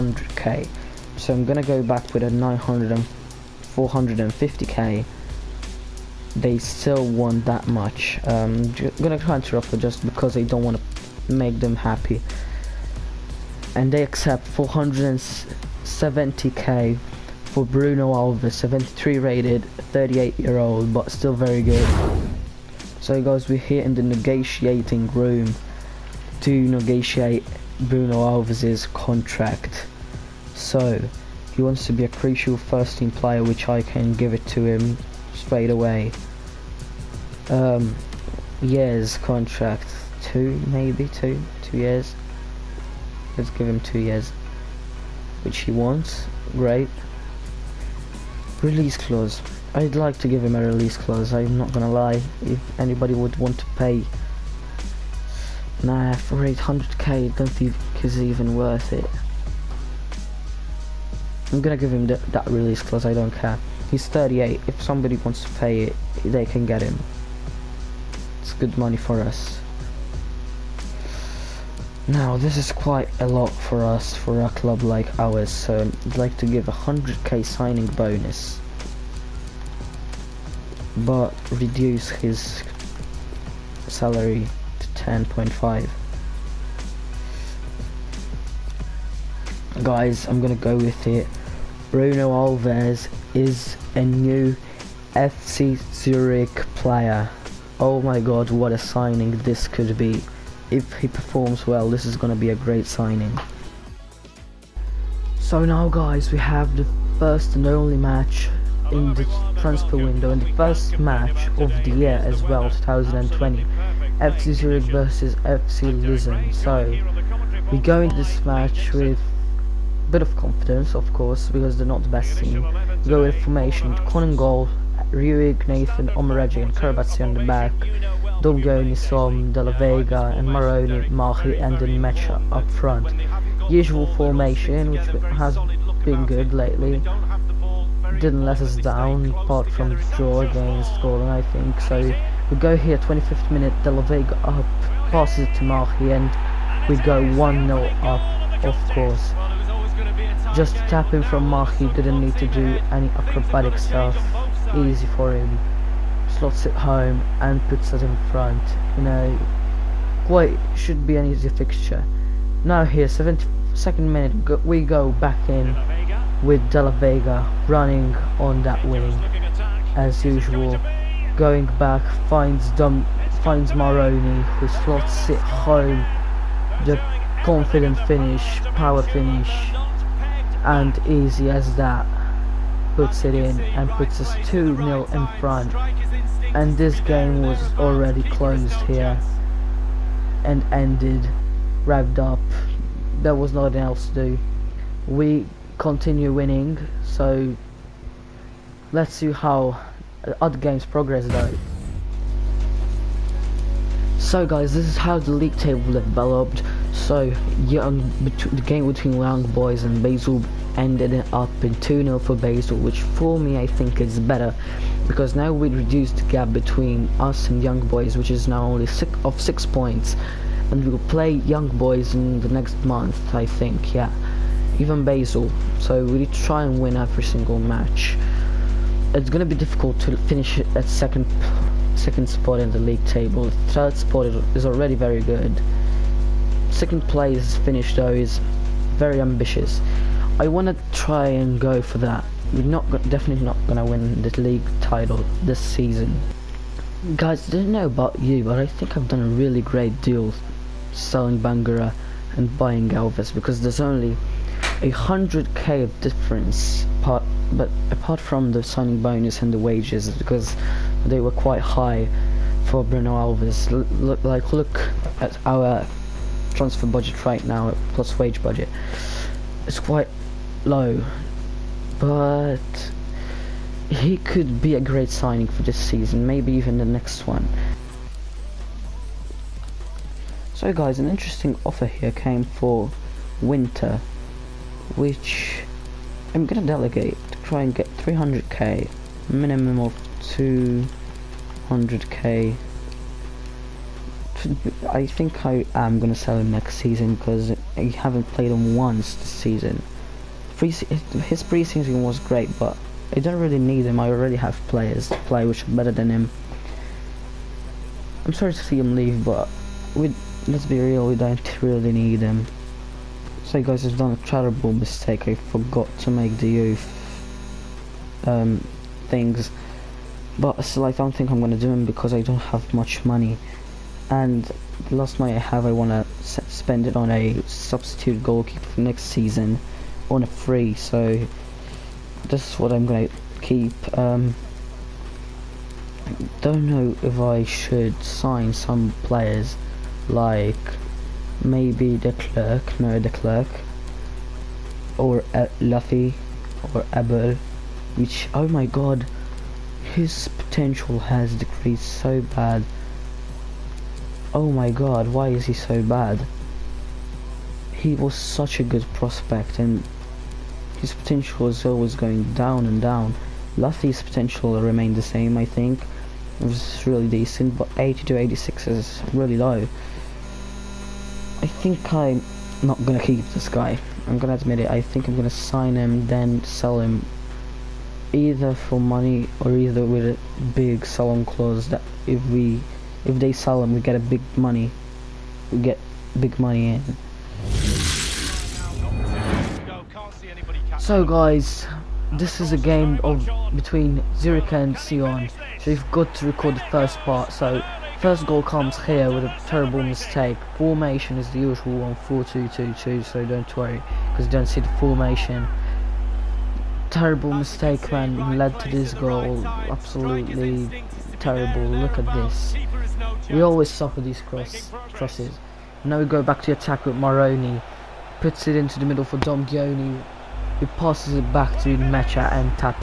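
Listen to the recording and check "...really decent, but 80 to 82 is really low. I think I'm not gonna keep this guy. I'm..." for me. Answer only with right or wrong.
wrong.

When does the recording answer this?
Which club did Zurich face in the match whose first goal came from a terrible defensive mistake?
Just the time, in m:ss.
6:34.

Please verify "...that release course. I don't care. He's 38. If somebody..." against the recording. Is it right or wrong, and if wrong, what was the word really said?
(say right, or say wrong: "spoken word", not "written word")
wrong: "clause", not "course".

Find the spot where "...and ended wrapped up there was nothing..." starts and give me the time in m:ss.
3:10.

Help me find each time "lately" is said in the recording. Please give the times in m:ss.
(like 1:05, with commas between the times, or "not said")
2:16.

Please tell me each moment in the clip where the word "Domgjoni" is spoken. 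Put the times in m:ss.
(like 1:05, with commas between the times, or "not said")
2:08, 6:59.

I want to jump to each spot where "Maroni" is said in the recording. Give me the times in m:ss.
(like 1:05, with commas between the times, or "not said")
2:10, 2:53, 6:56.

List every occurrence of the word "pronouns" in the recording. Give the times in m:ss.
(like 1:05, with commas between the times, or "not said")
not said.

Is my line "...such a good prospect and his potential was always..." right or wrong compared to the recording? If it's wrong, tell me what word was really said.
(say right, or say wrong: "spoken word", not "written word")
right.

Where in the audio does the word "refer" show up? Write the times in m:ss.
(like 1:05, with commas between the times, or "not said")
not said.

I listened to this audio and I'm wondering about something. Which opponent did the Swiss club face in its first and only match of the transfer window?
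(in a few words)
FC Lisbon.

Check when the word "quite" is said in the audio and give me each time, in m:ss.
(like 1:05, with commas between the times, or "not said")
1:12, 2:40, 4:21, 4:29.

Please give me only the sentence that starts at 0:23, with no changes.
So guys, we're here in the negotiating room to negotiate Bruno Alves's contract.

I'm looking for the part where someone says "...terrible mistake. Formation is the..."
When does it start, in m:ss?
6:39.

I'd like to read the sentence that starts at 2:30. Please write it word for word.
Just tapping from Mahi didn't need to do any acrobatic stuff easy for him.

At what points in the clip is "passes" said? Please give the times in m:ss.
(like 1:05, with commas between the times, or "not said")
2:25, 7:00.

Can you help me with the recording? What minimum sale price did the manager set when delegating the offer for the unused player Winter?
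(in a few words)
200k.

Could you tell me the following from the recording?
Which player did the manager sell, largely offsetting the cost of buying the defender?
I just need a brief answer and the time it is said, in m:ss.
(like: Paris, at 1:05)
Bangura, at 4:11.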